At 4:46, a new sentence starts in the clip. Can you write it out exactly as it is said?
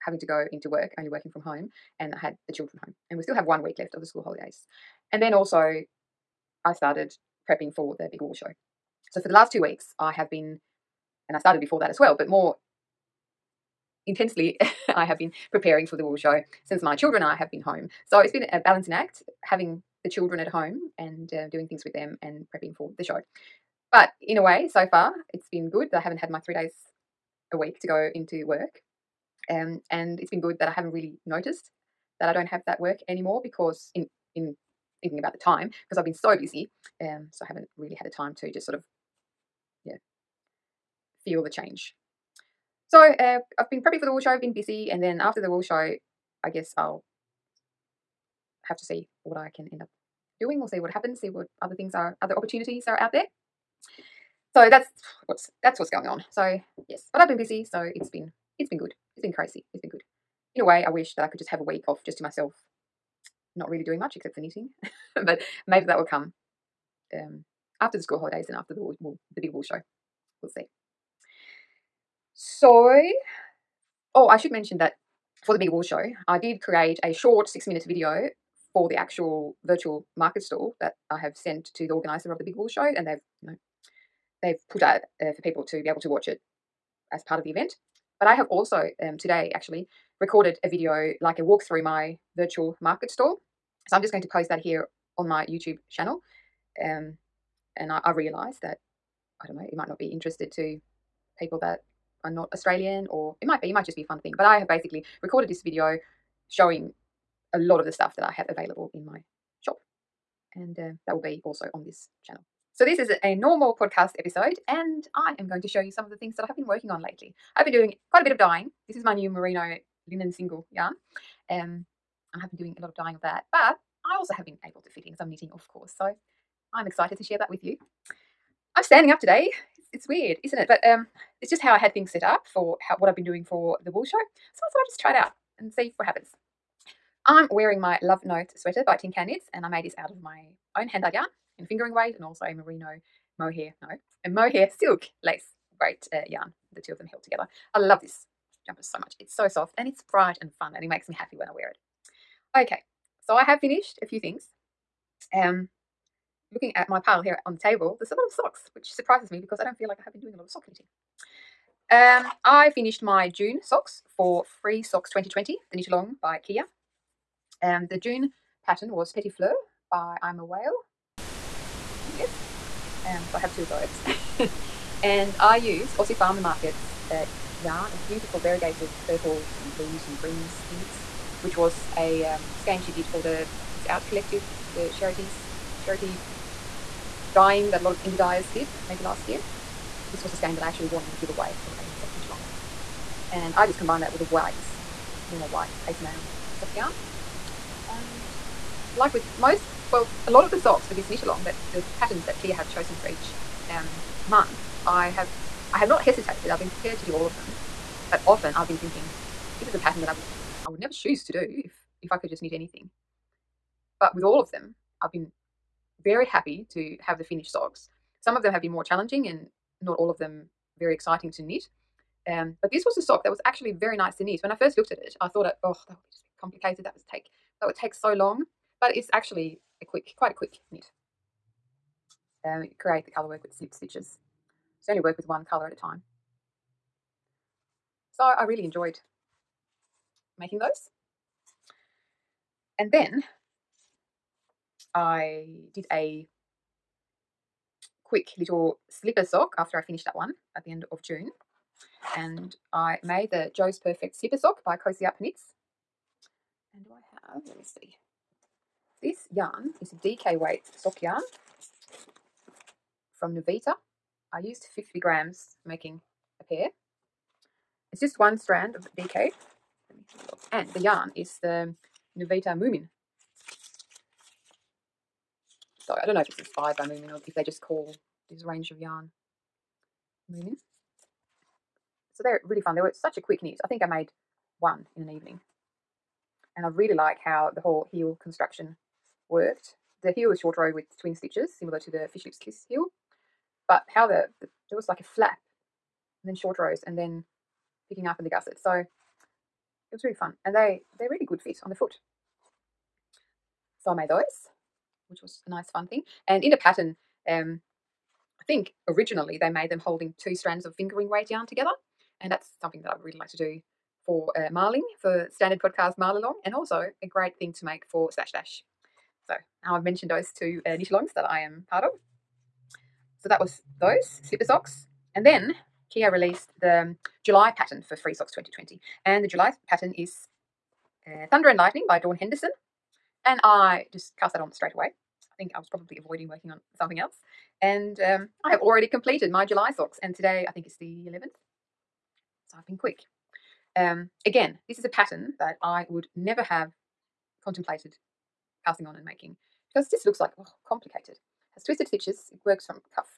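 And I really like how the whole heel construction worked.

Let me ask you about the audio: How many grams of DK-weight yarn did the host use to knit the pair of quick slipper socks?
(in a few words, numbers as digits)
50.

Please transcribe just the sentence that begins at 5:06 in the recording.
And in the pattern, um, I think originally they made them holding two strands of fingering weight yarn together.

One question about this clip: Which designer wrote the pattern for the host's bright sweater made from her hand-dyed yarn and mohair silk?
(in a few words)
Tin Can Knits.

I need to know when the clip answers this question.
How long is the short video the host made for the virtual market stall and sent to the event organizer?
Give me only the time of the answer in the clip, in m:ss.
1:17.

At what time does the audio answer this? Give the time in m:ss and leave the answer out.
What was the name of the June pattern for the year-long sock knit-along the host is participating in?
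2:49.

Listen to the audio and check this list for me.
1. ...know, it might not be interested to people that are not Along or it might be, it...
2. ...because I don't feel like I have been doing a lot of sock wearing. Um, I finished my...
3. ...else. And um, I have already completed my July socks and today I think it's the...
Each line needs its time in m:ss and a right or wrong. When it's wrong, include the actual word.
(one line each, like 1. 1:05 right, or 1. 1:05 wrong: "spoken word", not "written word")
1. 1:39 wrong: "Australian", not "Along"
2. 2:39 wrong: "knitting", not "wearing"
3. 5:36 right.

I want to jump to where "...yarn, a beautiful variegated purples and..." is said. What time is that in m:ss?
2:57.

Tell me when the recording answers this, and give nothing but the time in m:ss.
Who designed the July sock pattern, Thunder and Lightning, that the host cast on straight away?
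5:31.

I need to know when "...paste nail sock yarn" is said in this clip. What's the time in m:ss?
3:15.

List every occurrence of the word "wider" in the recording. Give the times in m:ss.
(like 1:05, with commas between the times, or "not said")
not said.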